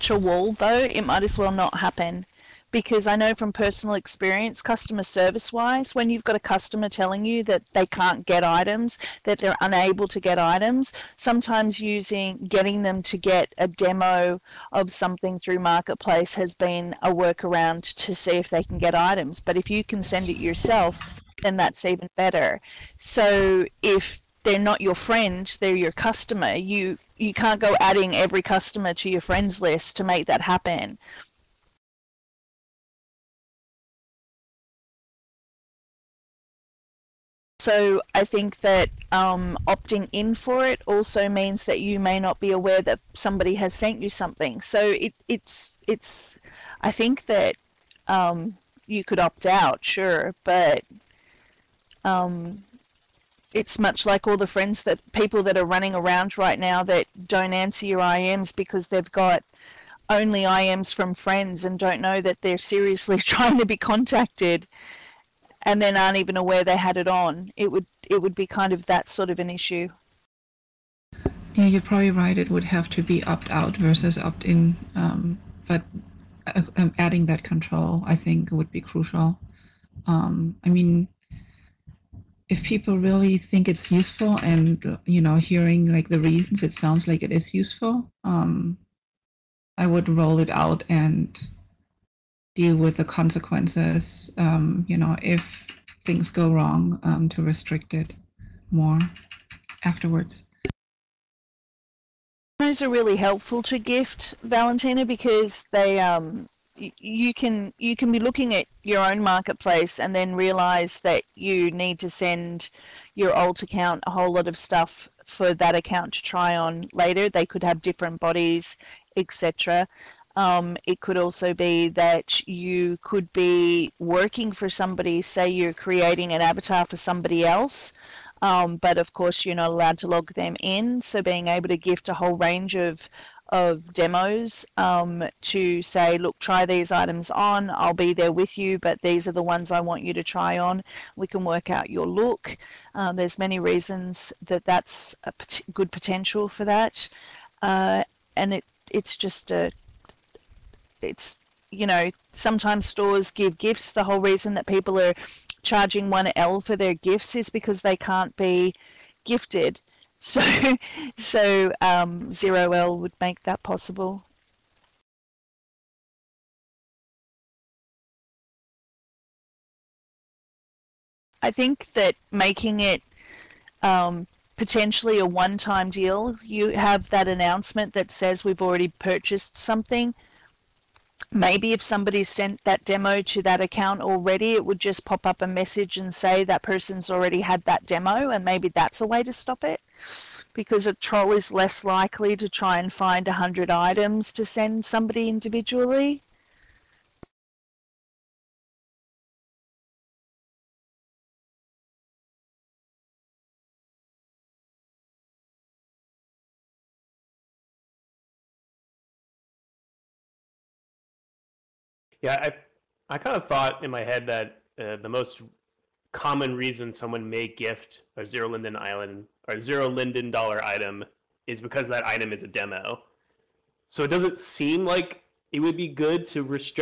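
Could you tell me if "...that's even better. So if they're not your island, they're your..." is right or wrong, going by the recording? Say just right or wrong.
wrong.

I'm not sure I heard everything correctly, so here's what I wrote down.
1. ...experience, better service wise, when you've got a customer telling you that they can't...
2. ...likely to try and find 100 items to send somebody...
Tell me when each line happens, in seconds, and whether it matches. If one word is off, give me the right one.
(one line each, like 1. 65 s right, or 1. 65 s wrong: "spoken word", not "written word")
1. 3 s wrong: "customer", not "better"
2. 191 s right.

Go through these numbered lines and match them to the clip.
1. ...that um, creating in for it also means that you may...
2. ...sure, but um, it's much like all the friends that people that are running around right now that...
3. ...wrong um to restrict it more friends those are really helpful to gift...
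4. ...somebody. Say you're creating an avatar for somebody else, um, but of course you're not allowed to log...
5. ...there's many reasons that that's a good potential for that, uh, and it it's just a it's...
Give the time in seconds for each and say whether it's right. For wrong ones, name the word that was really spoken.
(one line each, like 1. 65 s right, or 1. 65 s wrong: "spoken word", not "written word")
1. 38 s wrong: "opting", not "creating"
2. 49 s right
3. 96 s wrong: "afterwards", not "friends"
4. 124 s right
5. 143 s right.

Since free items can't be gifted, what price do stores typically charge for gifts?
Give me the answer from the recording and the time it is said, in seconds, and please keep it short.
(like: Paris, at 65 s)
1 L, at 156 s.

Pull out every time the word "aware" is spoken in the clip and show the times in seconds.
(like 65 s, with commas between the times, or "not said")
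42 s, 66 s.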